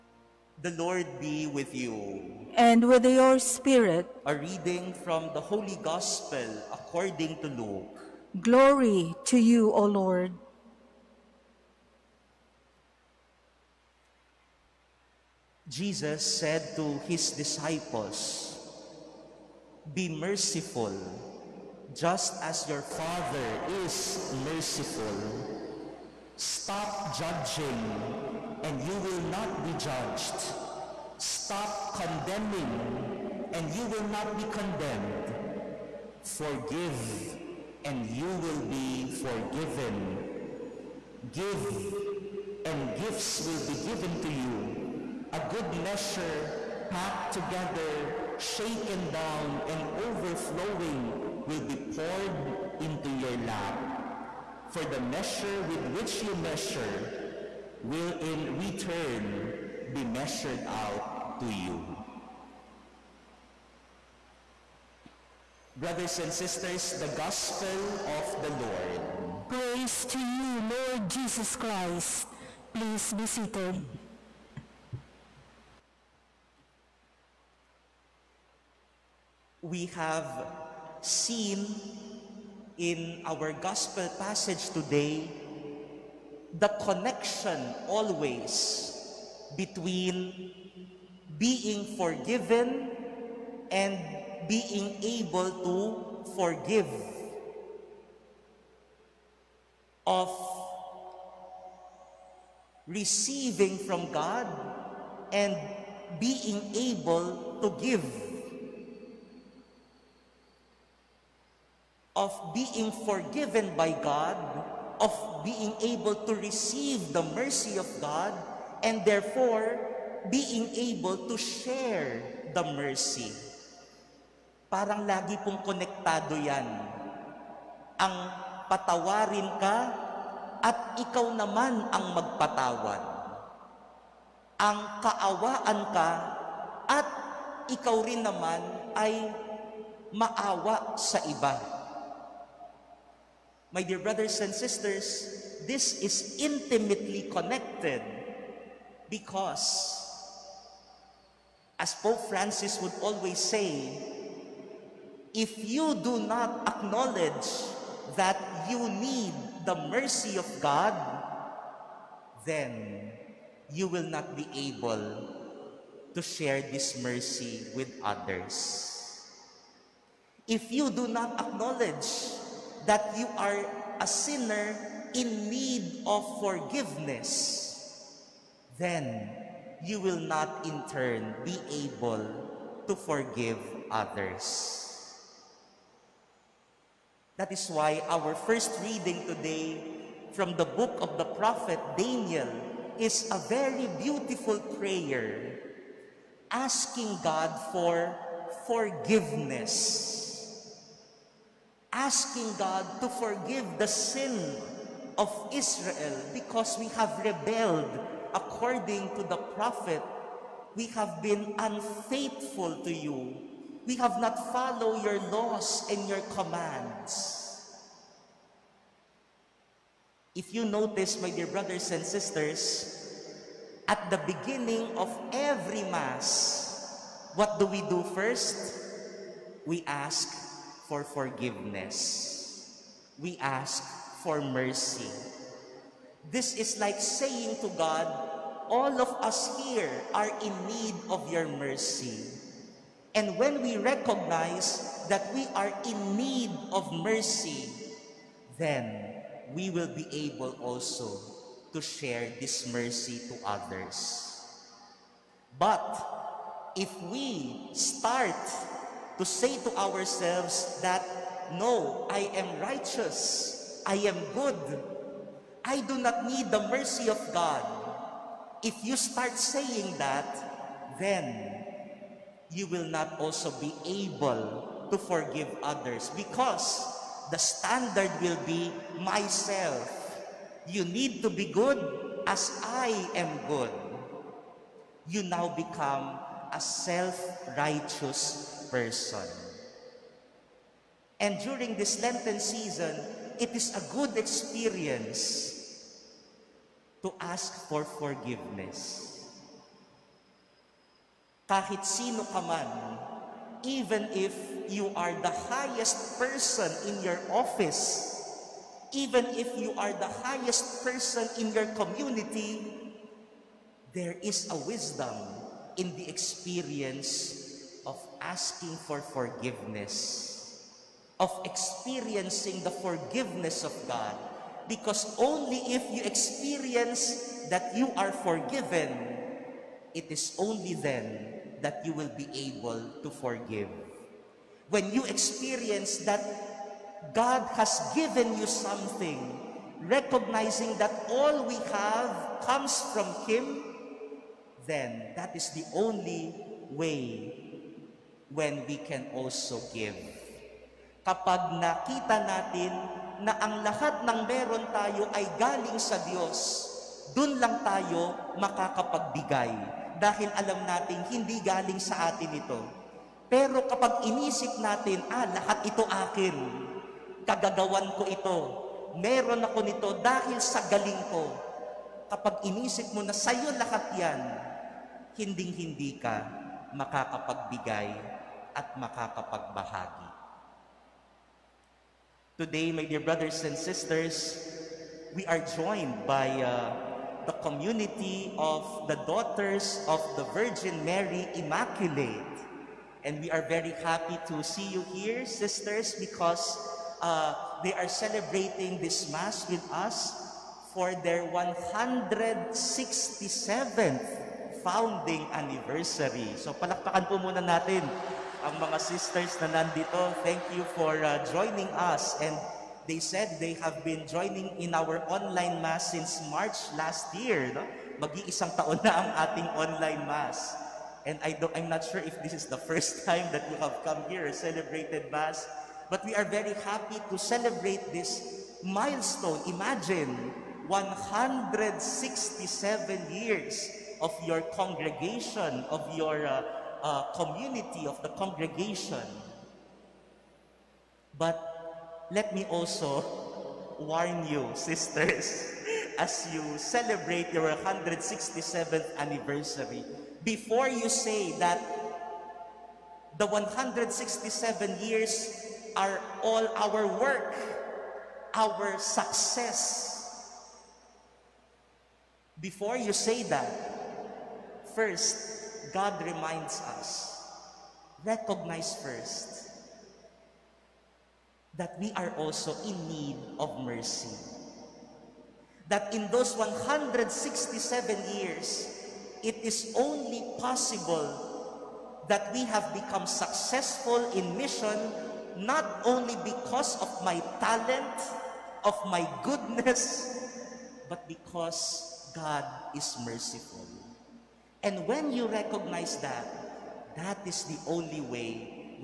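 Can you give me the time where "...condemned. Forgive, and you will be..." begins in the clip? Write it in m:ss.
0:34.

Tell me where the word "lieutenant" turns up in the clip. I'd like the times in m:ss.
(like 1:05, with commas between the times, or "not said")
not said.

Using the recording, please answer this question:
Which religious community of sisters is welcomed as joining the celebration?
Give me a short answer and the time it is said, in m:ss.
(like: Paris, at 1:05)
Daughters of the Virgin Mary Immaculate, at 6:29.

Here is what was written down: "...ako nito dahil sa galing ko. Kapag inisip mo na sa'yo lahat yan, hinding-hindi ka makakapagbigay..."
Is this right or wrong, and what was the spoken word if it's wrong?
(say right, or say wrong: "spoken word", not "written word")
right.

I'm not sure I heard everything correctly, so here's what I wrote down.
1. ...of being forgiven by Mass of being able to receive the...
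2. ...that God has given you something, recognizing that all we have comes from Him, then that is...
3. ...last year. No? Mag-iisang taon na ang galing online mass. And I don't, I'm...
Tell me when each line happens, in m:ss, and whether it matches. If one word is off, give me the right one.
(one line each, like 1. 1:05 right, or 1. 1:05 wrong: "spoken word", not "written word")
1. 1:52 wrong: "God", not "Mass"
2. 5:36 right
3. 6:56 wrong: "ating", not "galing".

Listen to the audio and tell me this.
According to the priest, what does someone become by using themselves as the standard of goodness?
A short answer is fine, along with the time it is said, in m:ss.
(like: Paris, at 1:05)
self-righteous person, at 4:46.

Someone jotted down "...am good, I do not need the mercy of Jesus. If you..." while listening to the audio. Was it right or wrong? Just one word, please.
wrong.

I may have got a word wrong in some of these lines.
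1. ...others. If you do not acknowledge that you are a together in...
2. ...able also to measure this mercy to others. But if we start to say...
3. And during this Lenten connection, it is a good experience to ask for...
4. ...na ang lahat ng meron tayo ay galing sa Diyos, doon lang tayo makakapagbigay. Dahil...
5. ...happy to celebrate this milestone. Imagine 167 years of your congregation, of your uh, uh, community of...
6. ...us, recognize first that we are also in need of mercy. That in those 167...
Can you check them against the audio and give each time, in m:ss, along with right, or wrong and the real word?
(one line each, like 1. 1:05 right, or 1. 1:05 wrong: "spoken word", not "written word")
1. 2:48 wrong: "sinner", not "together"
2. 4:10 wrong: "share", not "measure"
3. 4:51 wrong: "season", not "connection"
4. 5:53 right
5. 7:06 right
6. 7:46 right.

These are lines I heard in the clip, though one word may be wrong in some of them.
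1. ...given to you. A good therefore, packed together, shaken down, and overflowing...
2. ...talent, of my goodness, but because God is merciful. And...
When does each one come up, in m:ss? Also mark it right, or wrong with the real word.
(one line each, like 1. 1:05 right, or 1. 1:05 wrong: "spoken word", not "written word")
1. 0:43 wrong: "measure", not "therefore"
2. 8:07 right.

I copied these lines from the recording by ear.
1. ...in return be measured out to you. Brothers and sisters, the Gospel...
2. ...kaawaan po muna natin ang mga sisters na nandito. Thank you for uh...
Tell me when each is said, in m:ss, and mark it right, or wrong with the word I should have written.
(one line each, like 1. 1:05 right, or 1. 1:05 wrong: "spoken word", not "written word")
1. 0:58 right
2. 6:46 wrong: "palakpakan", not "kaawaan".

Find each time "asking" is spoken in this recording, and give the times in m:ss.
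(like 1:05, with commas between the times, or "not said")
3:16, 3:21, 5:18.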